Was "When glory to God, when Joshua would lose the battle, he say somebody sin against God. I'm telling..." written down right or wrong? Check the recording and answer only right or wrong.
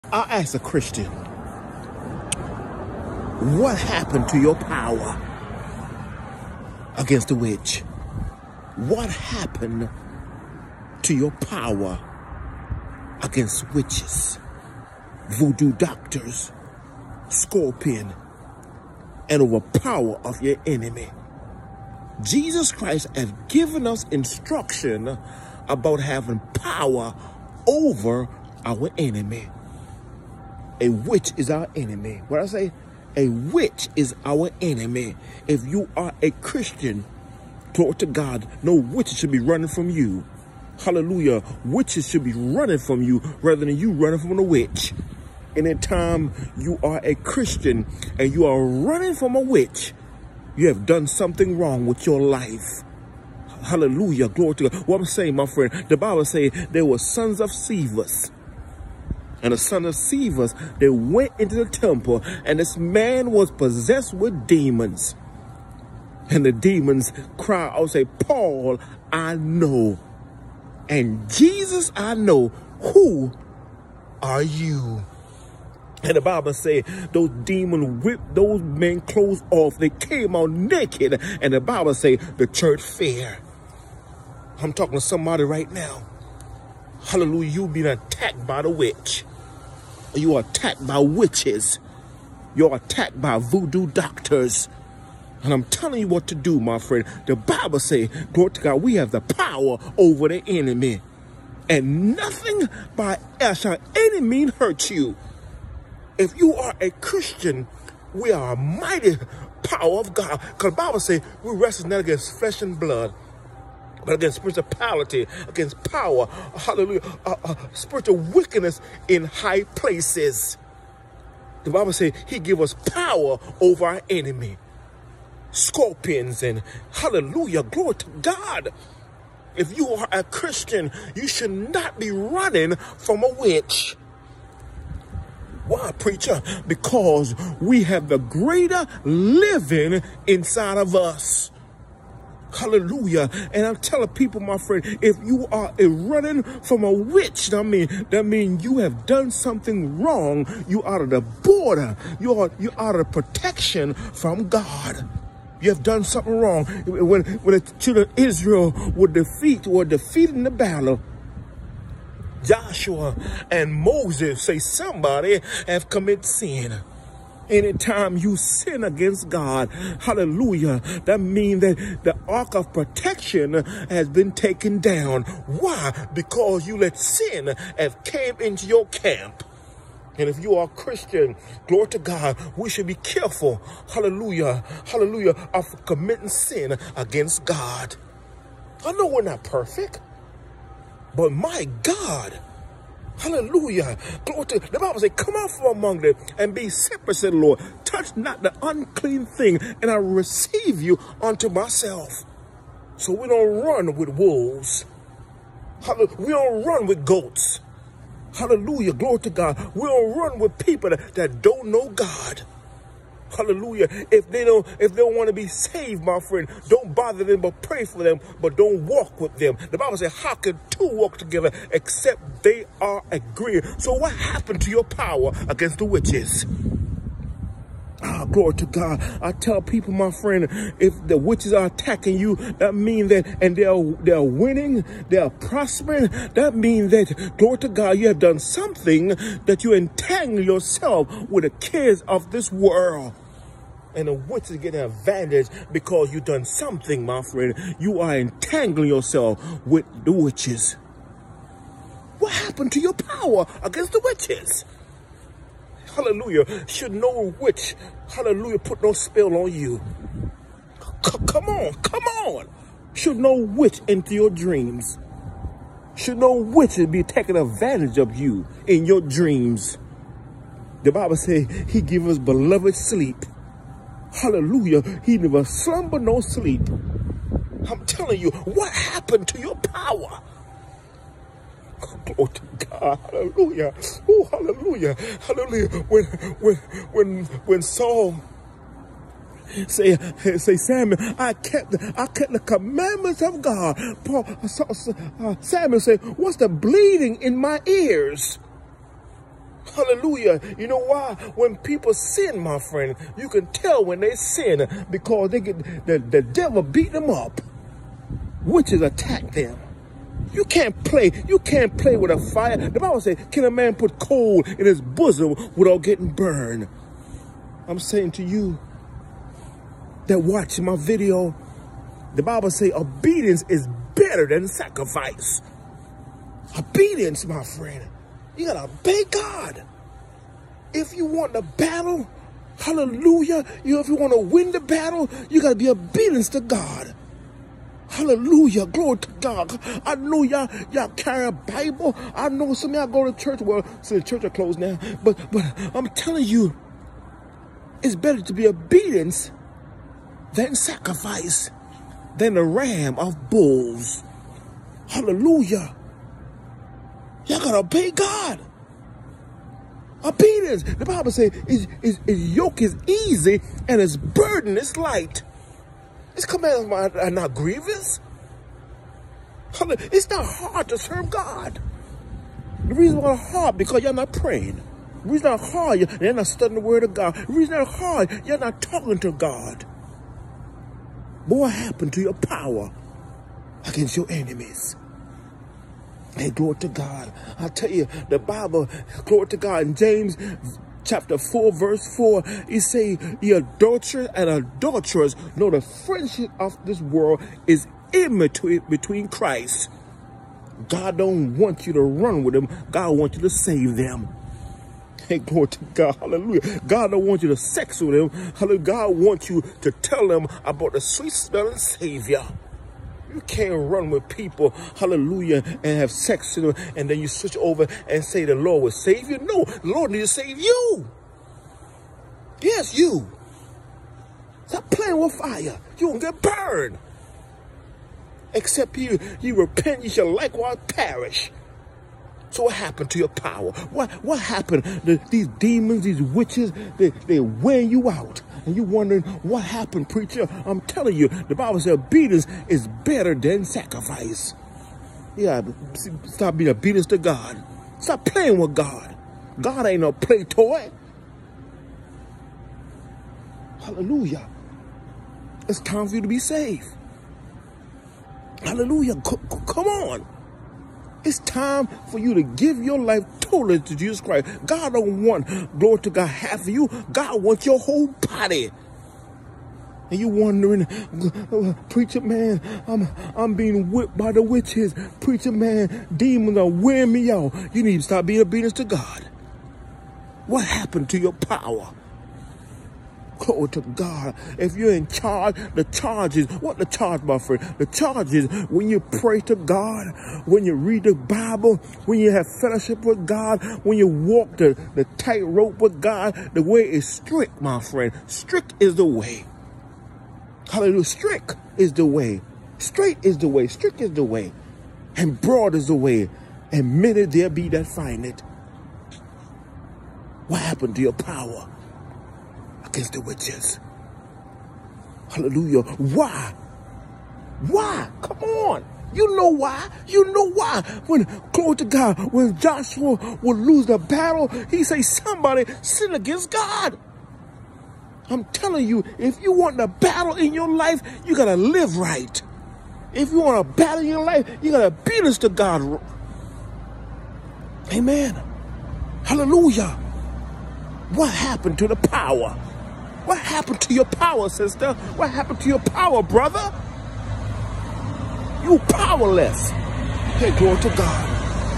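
right.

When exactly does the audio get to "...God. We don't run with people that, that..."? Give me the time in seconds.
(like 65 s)
209 s.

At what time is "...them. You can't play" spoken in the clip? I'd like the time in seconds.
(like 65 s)
309 s.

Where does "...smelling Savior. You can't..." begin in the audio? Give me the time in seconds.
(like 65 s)
411 s.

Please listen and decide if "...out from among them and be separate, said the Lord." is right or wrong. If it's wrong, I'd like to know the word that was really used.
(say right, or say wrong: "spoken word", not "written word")
right.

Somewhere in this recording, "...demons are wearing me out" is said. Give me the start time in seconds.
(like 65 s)
475 s.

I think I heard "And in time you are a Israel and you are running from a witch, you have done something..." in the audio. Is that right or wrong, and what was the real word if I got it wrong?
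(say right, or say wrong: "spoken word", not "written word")
wrong: "Christian", not "Israel".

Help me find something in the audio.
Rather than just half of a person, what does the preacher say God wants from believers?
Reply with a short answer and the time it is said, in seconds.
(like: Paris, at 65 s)
your whole body, at 467 s.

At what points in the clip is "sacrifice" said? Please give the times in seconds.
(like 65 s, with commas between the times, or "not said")
324 s, 350 s, 443 s.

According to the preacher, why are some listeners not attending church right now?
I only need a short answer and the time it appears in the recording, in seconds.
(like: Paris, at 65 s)
closed, at 344 s.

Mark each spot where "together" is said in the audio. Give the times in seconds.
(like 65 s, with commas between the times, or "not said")
221 s.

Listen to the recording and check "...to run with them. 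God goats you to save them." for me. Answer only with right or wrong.
wrong.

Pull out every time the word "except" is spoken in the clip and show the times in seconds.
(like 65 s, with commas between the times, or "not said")
221 s, 428 s.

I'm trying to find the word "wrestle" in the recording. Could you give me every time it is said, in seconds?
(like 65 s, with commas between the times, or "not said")
111 s.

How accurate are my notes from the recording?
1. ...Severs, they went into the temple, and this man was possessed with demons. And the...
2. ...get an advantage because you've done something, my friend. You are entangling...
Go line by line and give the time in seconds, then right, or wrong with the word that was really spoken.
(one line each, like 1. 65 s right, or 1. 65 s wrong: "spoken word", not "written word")
1. 59 s right
2. 244 s right.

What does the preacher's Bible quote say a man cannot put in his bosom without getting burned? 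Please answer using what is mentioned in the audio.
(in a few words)
coal.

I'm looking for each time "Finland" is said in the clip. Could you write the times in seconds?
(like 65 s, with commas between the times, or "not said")
not said.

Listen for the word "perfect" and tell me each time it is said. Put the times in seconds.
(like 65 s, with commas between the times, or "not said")
189 s.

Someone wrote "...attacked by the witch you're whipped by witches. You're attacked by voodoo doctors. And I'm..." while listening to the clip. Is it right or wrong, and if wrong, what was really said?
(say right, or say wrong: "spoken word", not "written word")
wrong: "attacked", not "whipped".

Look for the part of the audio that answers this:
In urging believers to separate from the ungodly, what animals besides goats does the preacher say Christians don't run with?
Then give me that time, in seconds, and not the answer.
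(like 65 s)
204 s.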